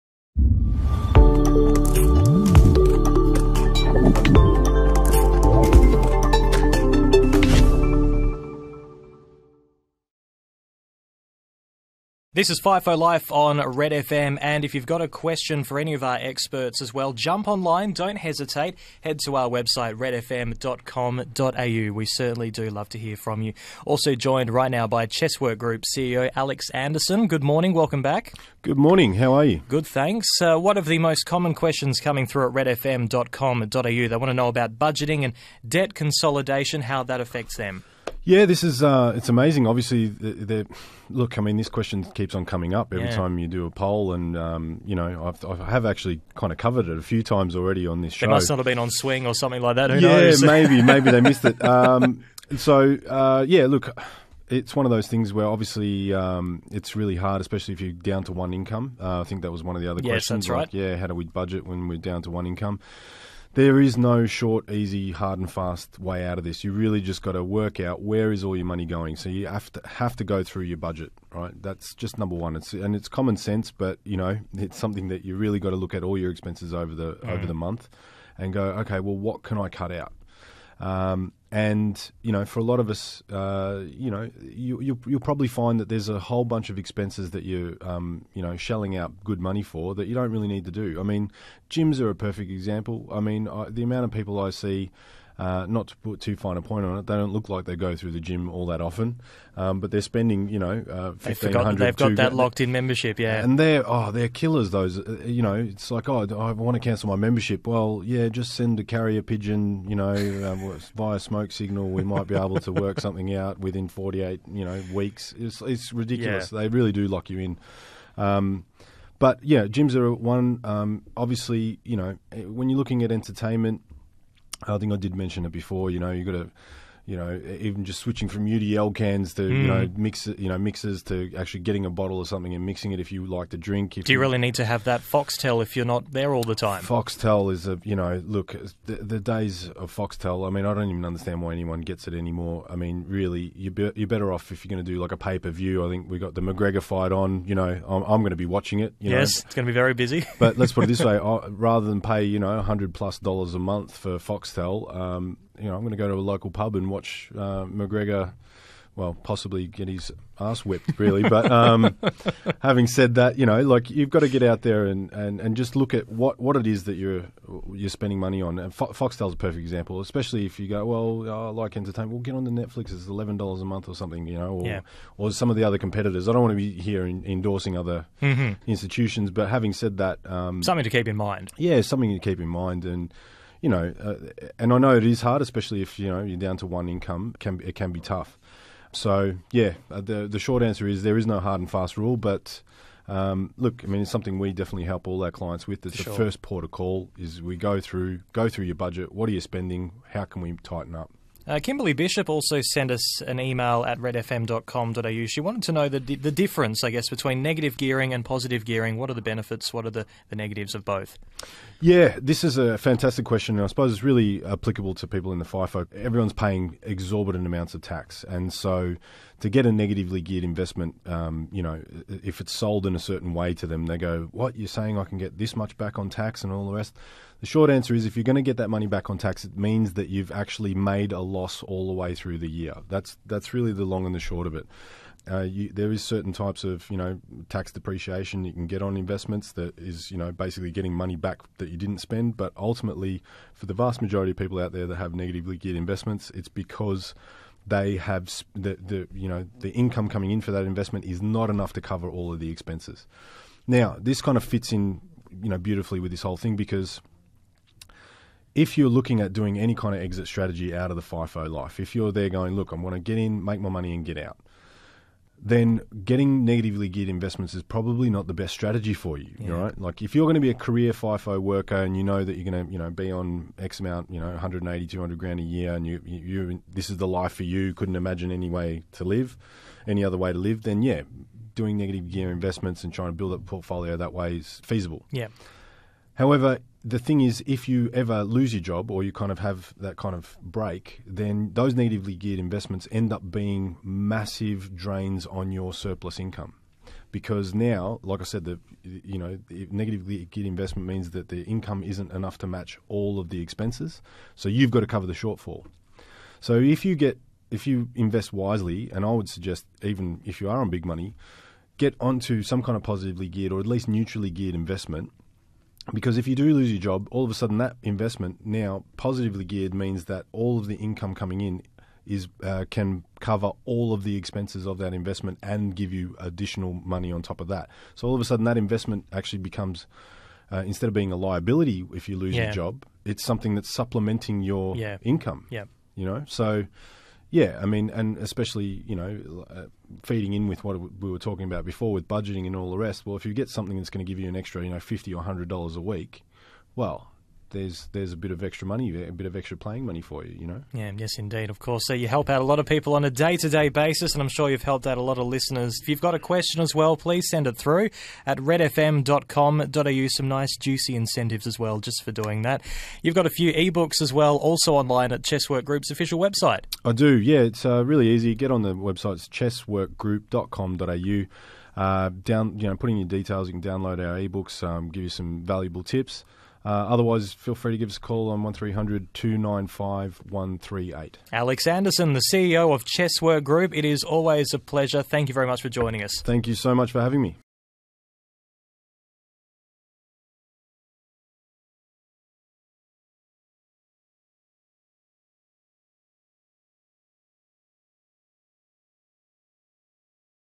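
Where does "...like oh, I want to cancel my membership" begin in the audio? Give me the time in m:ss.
1:45.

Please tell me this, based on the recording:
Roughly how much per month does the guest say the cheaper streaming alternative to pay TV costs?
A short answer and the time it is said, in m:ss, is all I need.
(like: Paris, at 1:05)
$11, at 2:53.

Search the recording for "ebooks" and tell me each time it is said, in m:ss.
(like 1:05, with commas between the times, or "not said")
6:03, 6:14.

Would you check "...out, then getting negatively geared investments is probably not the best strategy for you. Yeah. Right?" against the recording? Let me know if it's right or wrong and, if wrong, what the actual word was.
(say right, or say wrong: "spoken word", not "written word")
right.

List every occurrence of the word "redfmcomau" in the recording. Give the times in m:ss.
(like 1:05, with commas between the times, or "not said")
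0:19, 0:32, 3:23, 5:58.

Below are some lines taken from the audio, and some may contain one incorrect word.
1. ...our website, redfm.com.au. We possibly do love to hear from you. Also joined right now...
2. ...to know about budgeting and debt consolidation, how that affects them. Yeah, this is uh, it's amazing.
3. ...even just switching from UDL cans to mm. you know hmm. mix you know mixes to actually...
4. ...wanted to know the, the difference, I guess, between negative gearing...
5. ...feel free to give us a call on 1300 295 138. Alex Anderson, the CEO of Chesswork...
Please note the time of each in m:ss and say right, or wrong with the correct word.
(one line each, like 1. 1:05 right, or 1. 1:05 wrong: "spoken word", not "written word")
1. 0:19 wrong: "certainly", not "possibly"
2. 0:34 right
3. 2:07 right
4. 3:25 right
5. 6:17 right.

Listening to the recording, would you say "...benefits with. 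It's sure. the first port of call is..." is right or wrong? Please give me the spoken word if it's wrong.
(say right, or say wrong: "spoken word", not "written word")
wrong: "clients", not "benefits".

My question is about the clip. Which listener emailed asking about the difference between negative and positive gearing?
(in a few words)
Kimberly Bishop.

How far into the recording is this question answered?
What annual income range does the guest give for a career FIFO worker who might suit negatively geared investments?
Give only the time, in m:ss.
4:34.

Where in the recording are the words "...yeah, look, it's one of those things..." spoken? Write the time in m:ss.
0:53.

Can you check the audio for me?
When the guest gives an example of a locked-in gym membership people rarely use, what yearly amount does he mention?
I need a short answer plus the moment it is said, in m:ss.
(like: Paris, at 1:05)
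1500, at 1:41.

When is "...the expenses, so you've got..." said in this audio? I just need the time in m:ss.
5:03.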